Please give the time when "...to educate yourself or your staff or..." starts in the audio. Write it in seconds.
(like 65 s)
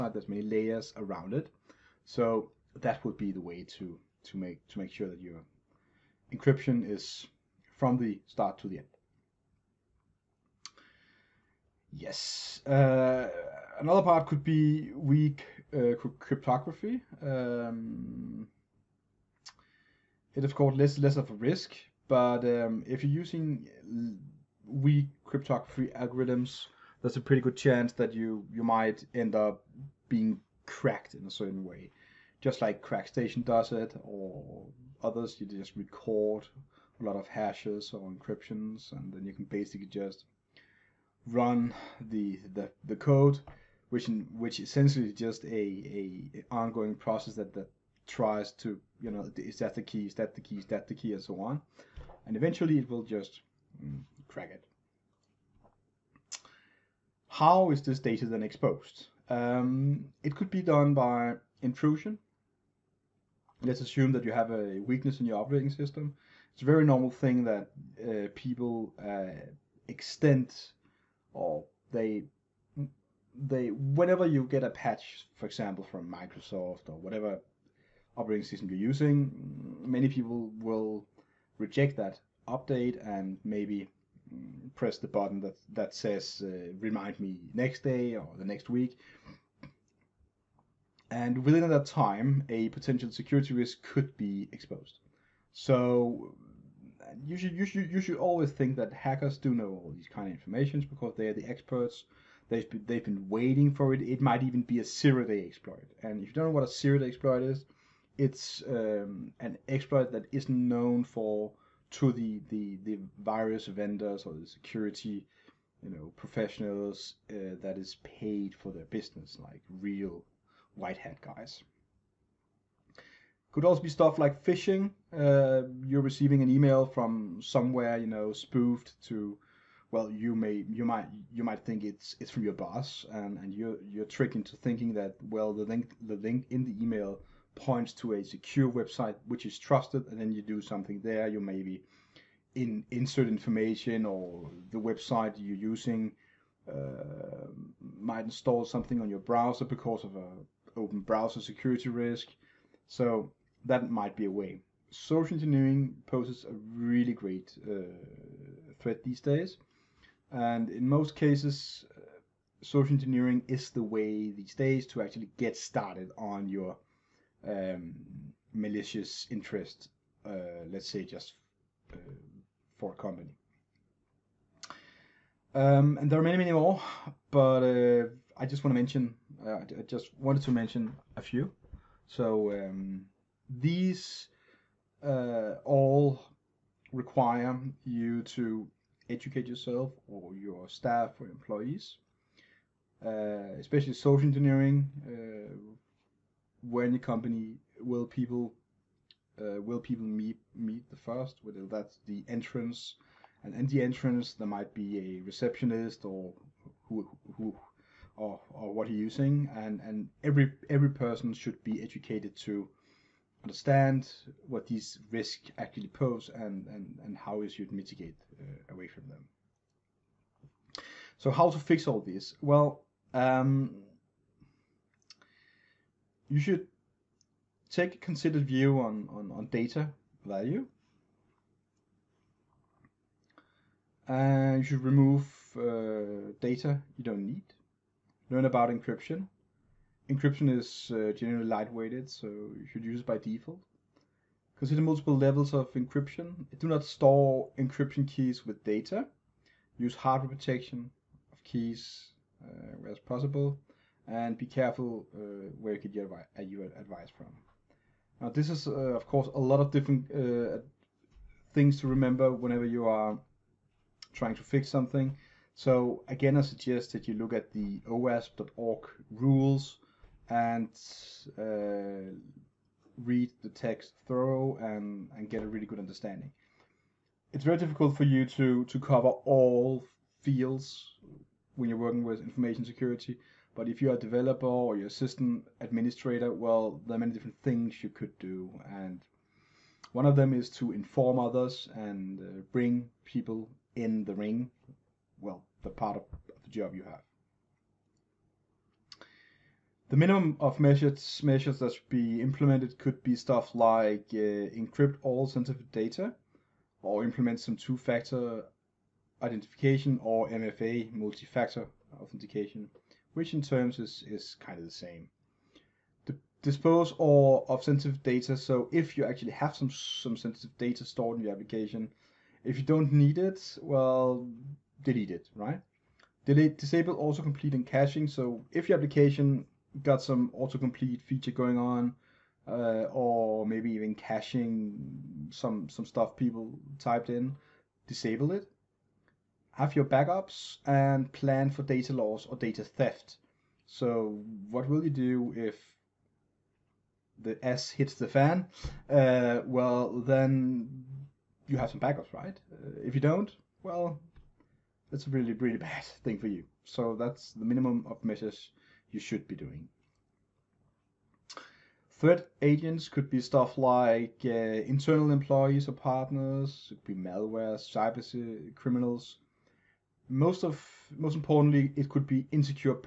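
188 s.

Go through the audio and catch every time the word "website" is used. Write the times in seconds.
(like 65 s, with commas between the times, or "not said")
138 s, 144 s.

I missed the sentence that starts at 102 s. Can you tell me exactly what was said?
They've been, they've been waiting for it.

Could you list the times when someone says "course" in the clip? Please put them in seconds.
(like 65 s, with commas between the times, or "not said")
20 s, 259 s.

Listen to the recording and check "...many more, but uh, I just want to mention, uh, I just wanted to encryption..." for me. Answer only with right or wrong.
wrong.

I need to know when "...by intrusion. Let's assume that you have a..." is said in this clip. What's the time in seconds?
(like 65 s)
60 s.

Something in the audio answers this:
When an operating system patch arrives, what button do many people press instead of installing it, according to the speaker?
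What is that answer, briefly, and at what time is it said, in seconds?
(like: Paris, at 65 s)
remind me next day, at 86 s.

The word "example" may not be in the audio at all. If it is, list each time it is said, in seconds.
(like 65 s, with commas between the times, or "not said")
75 s.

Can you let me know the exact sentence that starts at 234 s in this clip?
And you should remove uh, data you don't need.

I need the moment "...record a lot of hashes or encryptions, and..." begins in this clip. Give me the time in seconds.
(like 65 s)
35 s.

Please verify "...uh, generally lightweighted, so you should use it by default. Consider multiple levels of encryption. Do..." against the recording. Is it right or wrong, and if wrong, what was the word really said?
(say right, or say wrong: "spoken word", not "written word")
right.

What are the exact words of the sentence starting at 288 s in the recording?
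And one of them is to inform others and uh, bring people in the ring.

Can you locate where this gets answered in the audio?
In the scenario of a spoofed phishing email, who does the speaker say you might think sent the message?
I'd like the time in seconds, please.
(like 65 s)
132 s.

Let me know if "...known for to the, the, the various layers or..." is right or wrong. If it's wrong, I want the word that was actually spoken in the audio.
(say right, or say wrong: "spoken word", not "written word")
wrong: "vendors", not "layers".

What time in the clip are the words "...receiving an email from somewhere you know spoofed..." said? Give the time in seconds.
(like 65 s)
126 s.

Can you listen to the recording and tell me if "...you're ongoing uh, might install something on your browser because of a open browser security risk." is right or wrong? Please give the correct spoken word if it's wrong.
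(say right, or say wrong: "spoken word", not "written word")
wrong: "using", not "ongoing".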